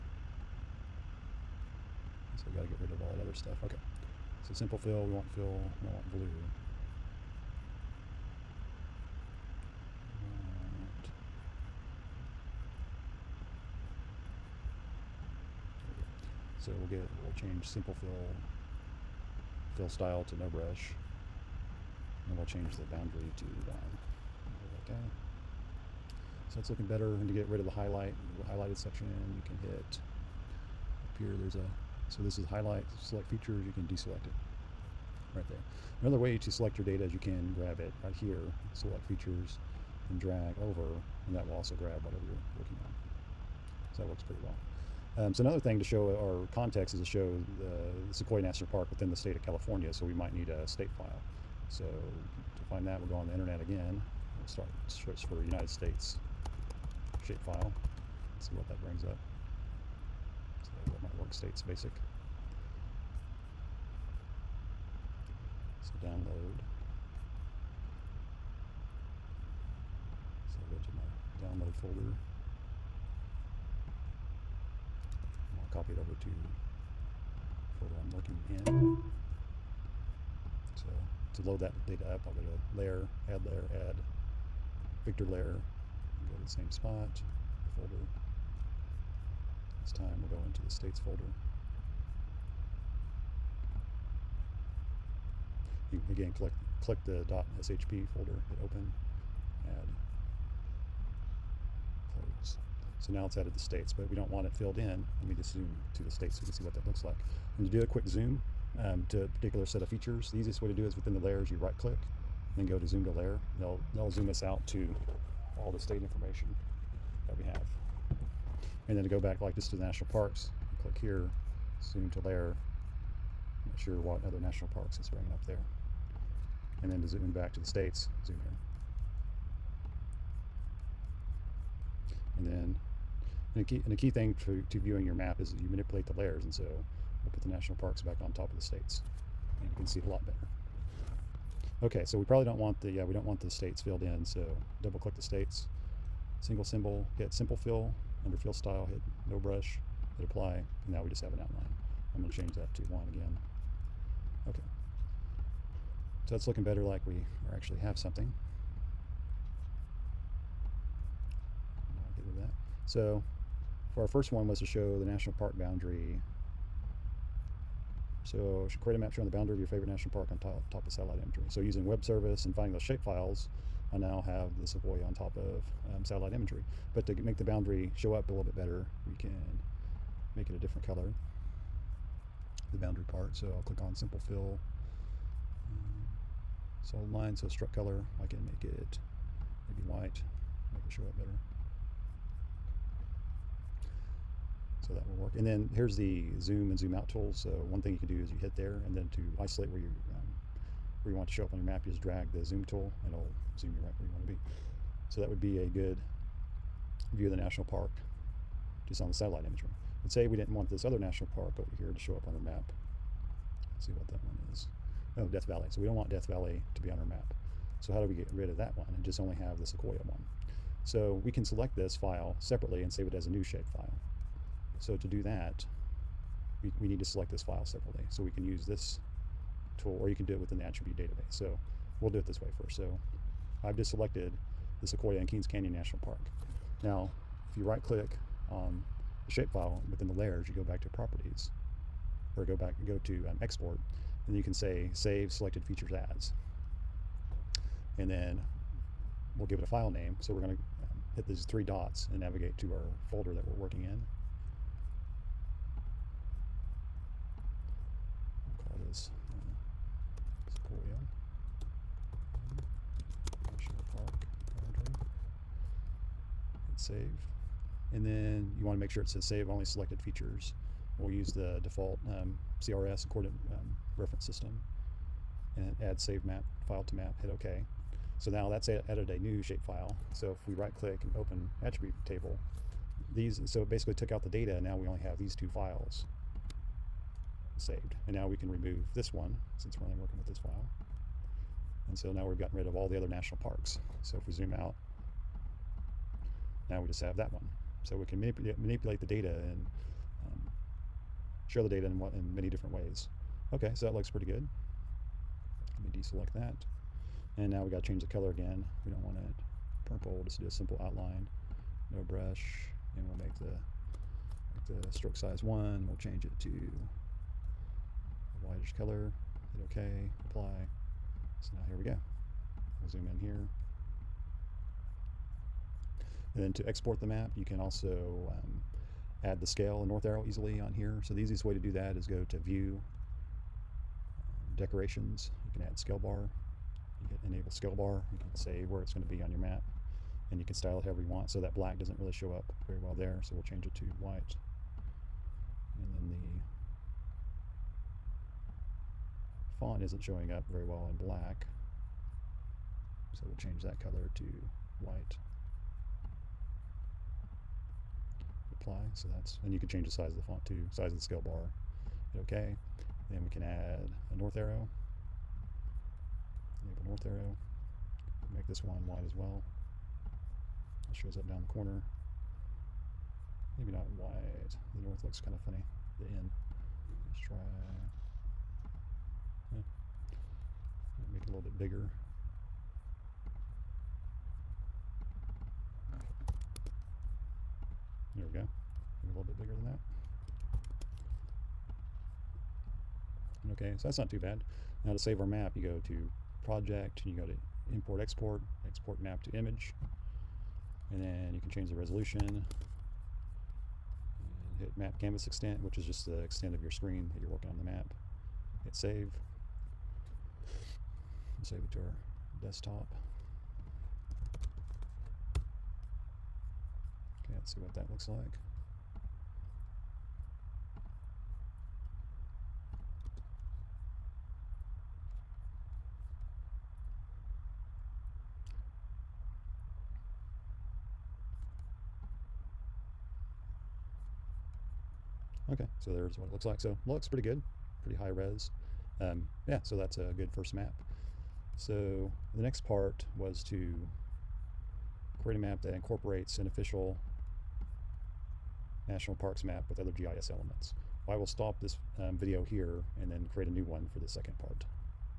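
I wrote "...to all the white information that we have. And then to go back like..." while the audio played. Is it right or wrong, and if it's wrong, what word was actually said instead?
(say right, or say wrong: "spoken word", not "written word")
wrong: "state", not "white".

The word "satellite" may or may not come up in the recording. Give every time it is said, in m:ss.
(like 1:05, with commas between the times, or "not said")
2:50, 2:56, 3:29.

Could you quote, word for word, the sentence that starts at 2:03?
I'm not sure what other national parks it's bringing up there.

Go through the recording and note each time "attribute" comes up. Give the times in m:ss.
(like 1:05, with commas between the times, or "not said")
3:50, 4:41.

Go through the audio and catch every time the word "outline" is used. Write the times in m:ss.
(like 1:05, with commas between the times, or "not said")
2:31, 5:10.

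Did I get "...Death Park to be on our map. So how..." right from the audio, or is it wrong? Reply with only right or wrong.
wrong.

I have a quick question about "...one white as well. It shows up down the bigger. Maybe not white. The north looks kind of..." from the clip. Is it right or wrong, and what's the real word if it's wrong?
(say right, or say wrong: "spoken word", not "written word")
wrong: "corner", not "bigger".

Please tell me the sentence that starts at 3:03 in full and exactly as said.
So I'll click on simple fill.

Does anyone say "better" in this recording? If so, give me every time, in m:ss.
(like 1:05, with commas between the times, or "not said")
0:26, 2:20, 2:36, 2:58, 3:11.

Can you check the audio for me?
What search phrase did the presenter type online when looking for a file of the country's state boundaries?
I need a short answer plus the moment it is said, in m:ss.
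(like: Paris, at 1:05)
United States shapefile, at 0:55.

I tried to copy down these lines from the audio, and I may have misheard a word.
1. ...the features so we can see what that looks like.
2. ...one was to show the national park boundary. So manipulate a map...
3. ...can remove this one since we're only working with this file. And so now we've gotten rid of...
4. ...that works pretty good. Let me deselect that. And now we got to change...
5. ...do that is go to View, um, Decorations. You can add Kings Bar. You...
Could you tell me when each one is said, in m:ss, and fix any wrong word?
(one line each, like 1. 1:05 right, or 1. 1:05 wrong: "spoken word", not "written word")
1. 1:46 wrong: "states", not "features"
2. 2:44 wrong: "create", not "manipulate"
3. 4:48 right
4. 5:03 wrong: "looks", not "works"
5. 5:31 wrong: "Scale", not "Kings".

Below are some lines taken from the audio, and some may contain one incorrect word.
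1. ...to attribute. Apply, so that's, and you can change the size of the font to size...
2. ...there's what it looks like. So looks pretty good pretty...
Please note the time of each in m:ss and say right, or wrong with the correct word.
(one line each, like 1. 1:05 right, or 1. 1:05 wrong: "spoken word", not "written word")
1. 5:54 wrong: "white", not "attribute"
2. 7:15 right.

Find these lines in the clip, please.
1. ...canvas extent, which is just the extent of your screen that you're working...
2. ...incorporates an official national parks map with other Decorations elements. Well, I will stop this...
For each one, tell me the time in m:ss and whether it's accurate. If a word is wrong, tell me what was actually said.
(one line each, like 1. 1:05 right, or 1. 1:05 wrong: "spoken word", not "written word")
1. 6:44 right
2. 7:25 wrong: "GIS", not "Decorations".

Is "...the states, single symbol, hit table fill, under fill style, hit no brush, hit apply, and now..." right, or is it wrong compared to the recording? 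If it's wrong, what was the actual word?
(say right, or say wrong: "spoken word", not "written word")
wrong: "simple", not "table".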